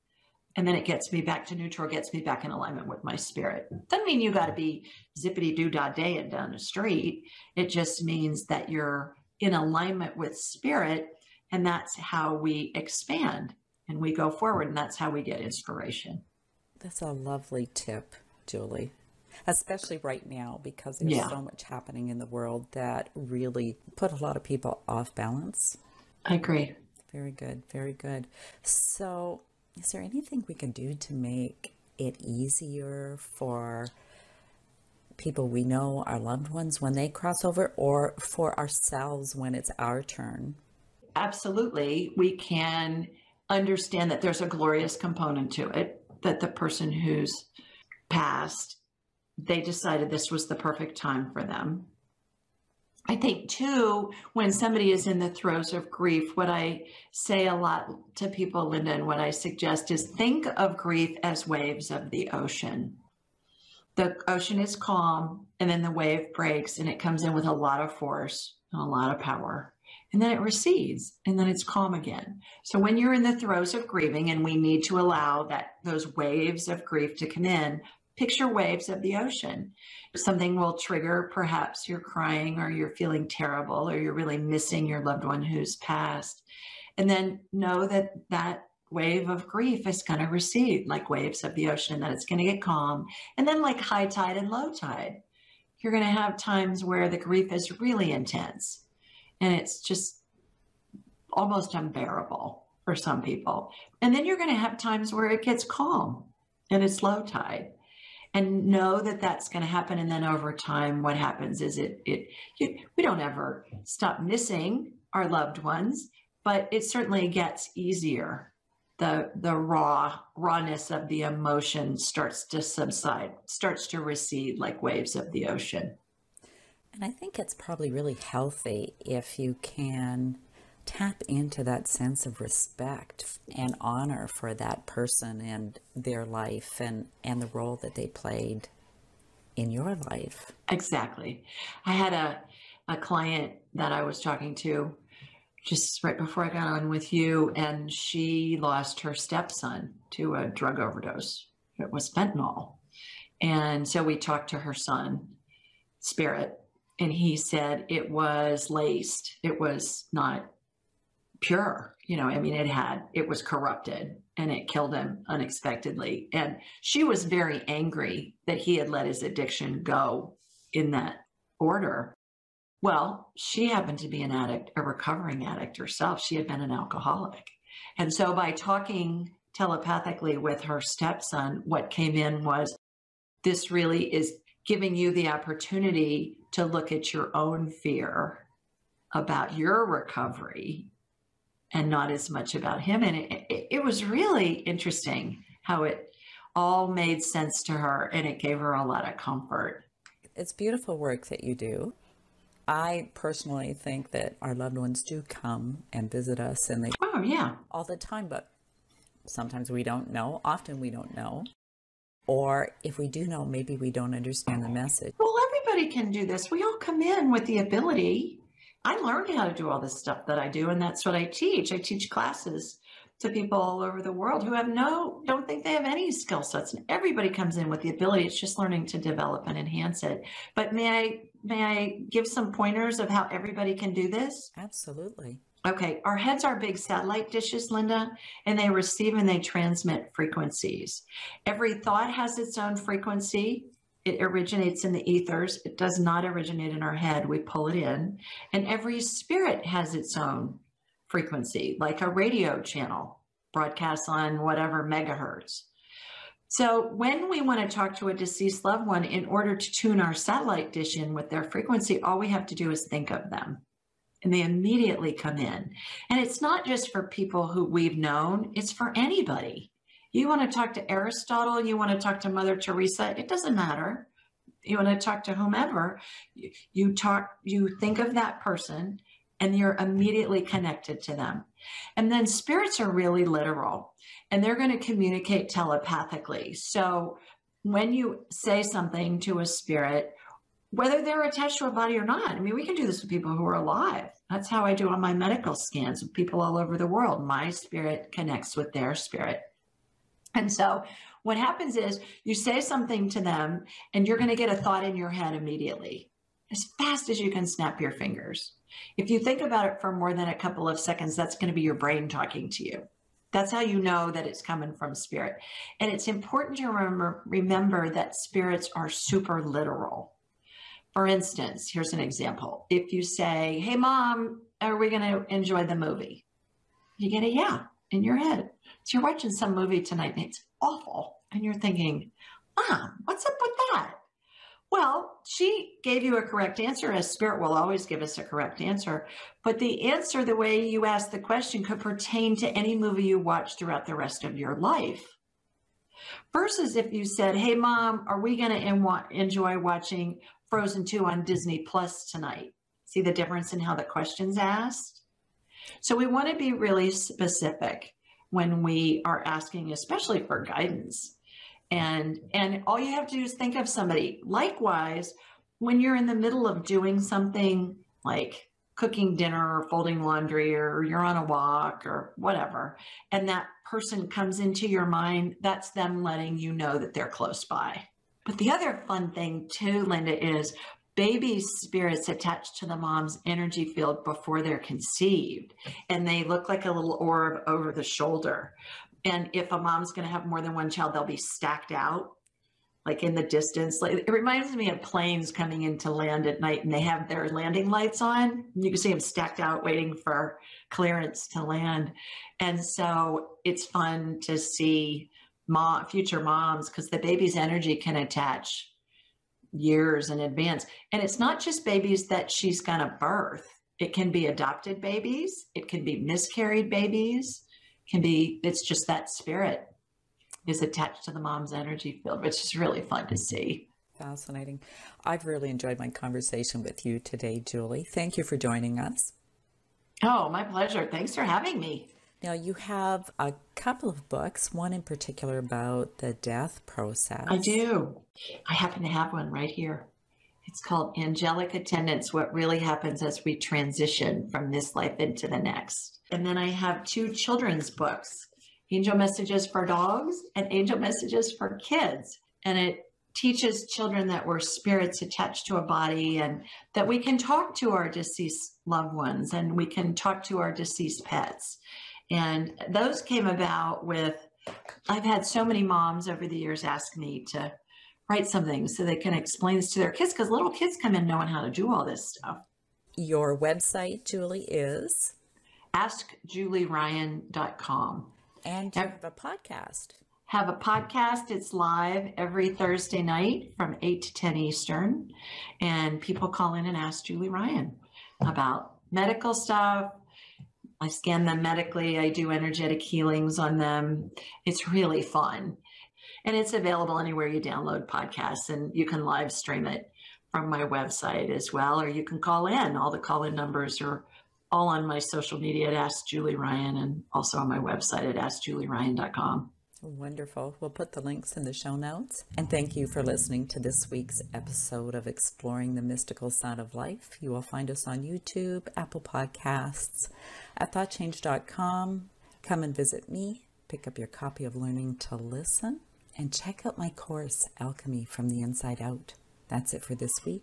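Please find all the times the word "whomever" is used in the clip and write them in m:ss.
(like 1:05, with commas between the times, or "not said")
4:35.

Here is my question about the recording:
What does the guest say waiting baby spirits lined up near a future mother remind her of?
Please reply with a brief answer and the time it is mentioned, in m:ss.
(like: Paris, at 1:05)
Planes coming in to land, at 6:34.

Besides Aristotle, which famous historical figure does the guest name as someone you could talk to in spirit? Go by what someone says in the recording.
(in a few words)
Mother Teresa.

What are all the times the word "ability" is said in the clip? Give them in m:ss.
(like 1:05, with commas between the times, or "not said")
3:37, 3:47.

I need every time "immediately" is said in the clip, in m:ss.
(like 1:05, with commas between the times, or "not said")
4:24, 4:39, 5:05.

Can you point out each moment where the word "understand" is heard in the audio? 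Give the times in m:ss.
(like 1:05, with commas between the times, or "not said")
0:43, 3:34.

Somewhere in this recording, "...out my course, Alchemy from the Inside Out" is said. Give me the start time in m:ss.
8:46.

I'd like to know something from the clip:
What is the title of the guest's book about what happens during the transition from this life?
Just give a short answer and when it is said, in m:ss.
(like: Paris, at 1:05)
Angelic Attendants, at 7:20.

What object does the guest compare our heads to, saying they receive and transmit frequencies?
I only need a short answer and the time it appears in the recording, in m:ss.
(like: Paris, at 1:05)
Satellite dishes, at 3:56.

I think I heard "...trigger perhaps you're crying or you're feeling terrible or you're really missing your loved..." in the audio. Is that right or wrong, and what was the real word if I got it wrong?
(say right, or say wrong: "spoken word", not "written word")
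right.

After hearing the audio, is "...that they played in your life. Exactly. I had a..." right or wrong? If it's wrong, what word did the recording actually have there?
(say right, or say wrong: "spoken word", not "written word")
right.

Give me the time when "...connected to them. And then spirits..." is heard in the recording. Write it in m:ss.
4:40.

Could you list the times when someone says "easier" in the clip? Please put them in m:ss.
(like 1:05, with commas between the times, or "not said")
0:32, 1:57.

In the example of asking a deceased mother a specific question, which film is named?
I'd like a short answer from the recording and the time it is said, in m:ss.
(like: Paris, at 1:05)
Frozen 2, at 5:50.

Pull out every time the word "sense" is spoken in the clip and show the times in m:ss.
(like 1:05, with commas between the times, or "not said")
2:11, 3:17.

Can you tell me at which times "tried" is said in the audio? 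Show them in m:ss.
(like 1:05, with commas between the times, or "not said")
not said.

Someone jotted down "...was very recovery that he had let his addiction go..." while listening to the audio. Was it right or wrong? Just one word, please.
wrong.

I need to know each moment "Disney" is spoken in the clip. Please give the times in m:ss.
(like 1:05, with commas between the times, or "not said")
5:51.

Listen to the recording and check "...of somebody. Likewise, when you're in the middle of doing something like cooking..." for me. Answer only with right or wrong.
right.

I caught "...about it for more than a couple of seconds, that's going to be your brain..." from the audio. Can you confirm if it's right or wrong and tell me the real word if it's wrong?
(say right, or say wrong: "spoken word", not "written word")
right.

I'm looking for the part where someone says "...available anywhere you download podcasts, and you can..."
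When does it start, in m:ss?
8:16.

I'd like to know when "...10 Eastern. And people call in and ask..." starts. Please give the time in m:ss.
8:04.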